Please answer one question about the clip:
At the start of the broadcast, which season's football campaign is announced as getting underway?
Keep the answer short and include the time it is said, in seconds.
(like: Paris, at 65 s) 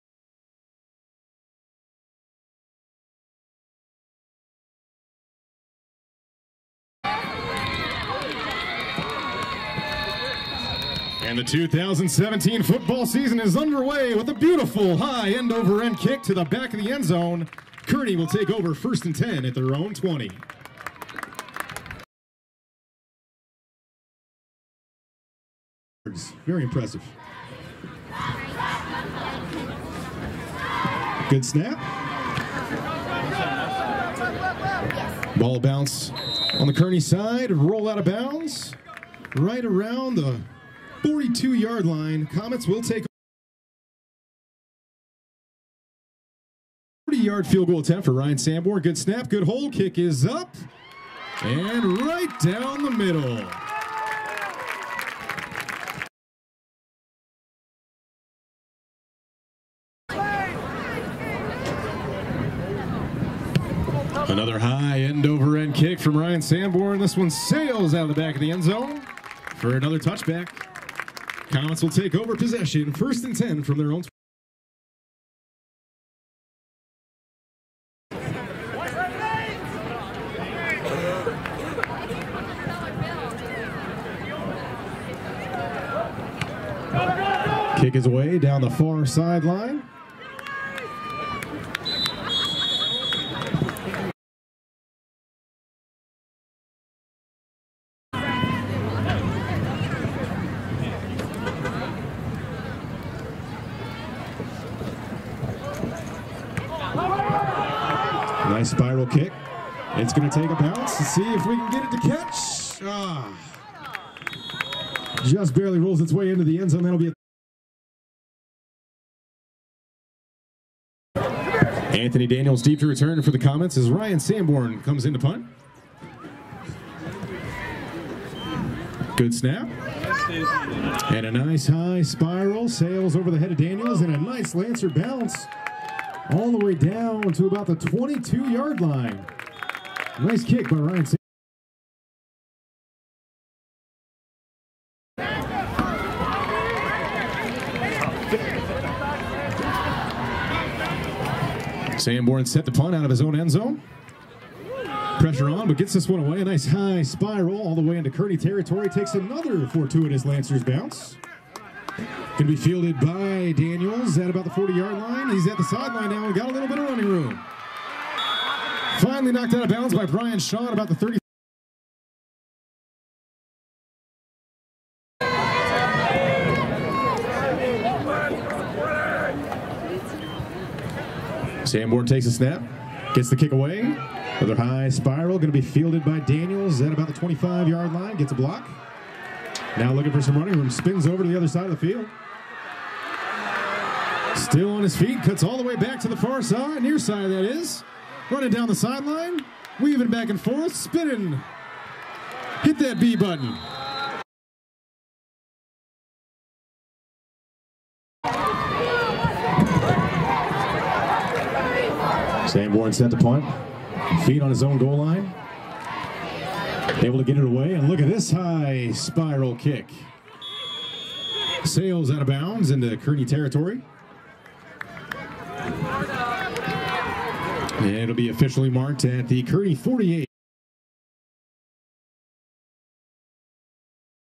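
2017, at 11 s.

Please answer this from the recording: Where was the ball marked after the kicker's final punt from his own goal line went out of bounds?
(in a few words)
Kearny 48.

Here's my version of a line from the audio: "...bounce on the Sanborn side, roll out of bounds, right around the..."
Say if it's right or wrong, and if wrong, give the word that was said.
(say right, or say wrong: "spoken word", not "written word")
wrong: "Kearny", not "Sanborn".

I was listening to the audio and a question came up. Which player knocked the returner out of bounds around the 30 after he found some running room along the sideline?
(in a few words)
Brian Shaw.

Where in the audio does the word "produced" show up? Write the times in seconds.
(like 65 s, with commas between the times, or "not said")
not said.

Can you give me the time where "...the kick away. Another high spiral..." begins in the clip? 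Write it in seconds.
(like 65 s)
183 s.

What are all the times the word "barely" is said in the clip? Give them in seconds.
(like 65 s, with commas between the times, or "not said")
115 s.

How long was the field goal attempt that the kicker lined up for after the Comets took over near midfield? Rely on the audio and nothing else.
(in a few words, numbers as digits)
40 yards.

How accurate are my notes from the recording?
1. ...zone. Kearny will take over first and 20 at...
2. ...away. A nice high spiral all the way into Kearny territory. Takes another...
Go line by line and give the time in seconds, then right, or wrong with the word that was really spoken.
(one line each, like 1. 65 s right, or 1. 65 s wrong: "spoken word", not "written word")
1. 17 s wrong: "10", not "20"
2. 156 s right.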